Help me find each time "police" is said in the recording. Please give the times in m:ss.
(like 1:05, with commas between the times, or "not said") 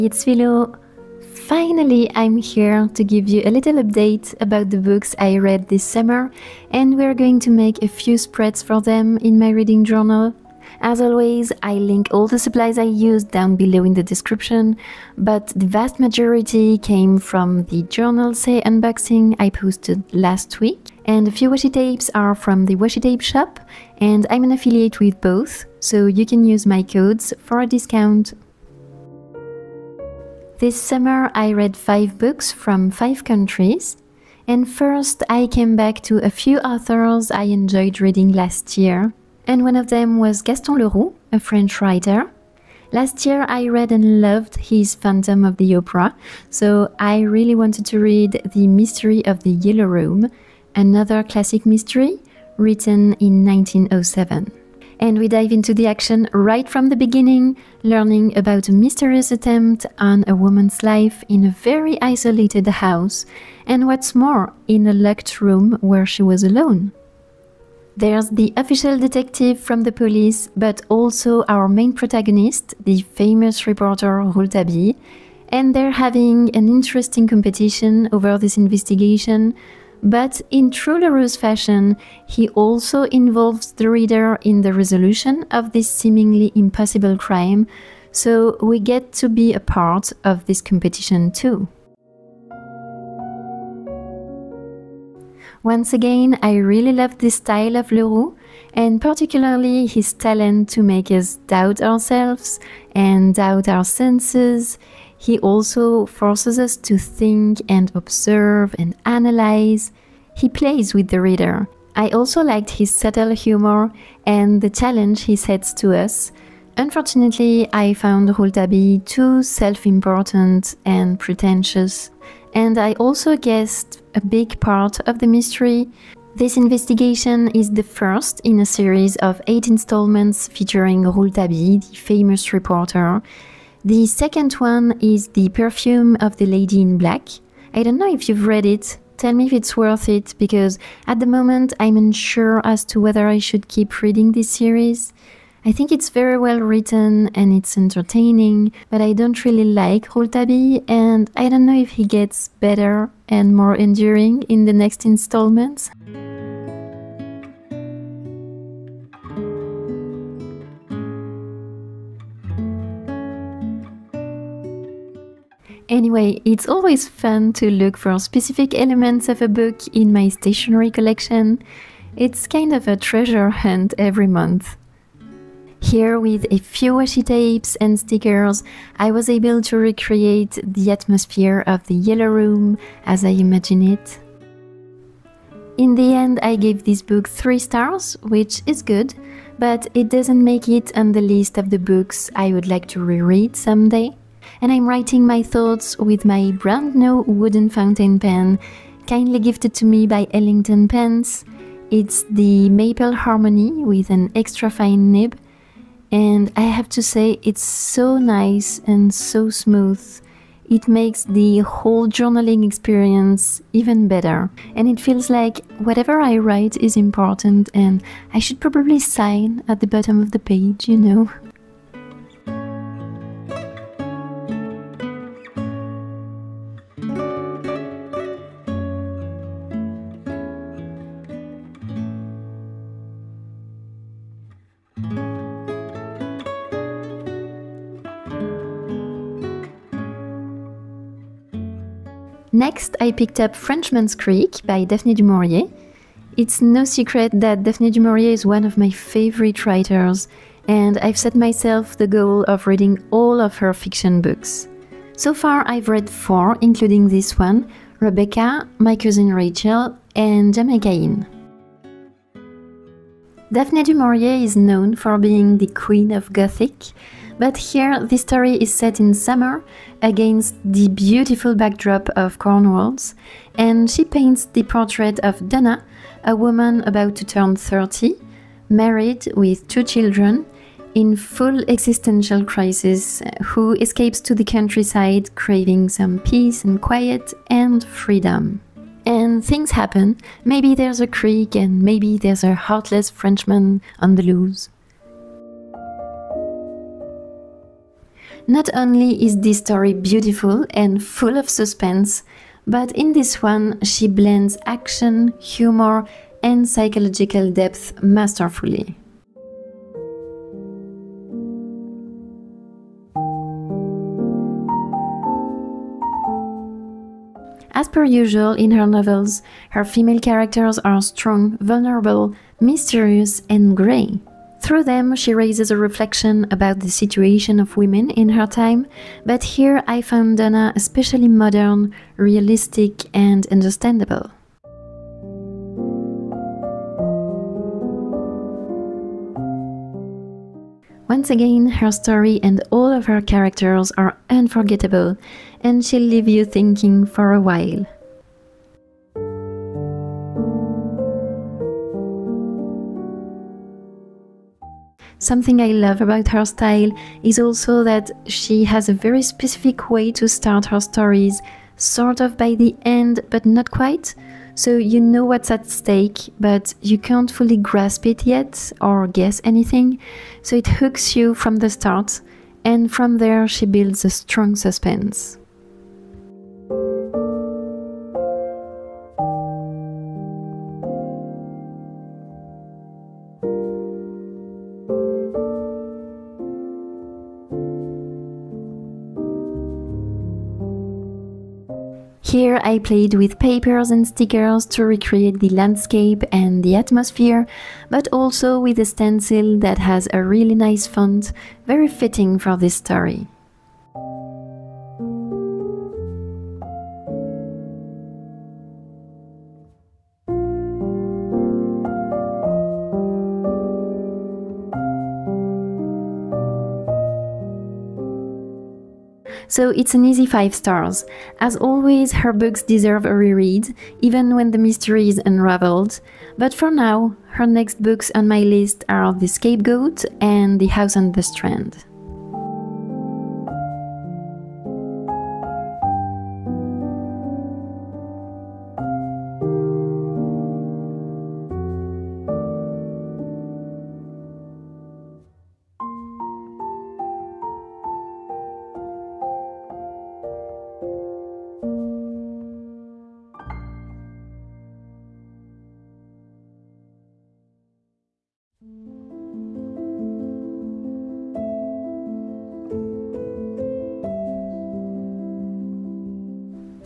1:09.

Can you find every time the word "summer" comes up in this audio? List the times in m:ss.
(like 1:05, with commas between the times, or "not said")
0:05, 0:30, 4:29.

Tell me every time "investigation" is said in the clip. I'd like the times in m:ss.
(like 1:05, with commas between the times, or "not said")
1:18, 2:06.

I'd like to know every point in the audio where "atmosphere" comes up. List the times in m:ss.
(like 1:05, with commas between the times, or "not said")
3:00, 6:36.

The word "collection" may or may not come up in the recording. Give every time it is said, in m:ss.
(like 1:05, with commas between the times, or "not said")
2:50.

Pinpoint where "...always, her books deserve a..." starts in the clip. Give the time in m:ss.
7:01.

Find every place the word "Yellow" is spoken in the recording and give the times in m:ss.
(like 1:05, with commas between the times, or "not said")
0:49, 3:01.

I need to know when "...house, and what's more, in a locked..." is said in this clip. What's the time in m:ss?
1:02.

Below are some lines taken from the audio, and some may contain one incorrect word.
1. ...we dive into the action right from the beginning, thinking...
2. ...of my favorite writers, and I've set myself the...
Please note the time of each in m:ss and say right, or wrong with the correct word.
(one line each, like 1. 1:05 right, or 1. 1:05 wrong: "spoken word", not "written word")
1. 0:55 wrong: "learning", not "thinking"
2. 4:08 right.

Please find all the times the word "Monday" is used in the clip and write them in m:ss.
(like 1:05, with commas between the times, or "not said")
not said.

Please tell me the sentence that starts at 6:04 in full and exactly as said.
So you know what's at stake, but you can't fully grasp it yet or guess anything.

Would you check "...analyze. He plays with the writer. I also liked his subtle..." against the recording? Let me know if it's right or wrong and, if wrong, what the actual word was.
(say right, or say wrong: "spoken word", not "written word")
wrong: "reader", not "writer".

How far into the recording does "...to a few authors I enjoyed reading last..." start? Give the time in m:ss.
0:36.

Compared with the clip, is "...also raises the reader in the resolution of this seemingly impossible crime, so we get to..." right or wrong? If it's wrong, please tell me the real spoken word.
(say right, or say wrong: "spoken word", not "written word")
wrong: "involves", not "raises".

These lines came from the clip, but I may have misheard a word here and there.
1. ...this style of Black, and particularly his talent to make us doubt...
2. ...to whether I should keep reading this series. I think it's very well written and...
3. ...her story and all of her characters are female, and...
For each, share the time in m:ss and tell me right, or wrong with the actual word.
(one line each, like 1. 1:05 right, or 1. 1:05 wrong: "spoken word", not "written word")
1. 1:37 wrong: "Leroux", not "Black"
2. 2:22 right
3. 5:41 wrong: "unforgettable", not "female".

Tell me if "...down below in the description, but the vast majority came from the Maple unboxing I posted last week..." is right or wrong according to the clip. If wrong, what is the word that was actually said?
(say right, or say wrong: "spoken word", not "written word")
wrong: "Journalsay", not "Maple".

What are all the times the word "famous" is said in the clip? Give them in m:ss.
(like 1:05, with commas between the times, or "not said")
1:13, 2:11.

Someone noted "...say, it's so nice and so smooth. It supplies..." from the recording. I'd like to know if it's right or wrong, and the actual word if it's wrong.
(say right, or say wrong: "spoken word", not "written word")
wrong: "makes", not "supplies".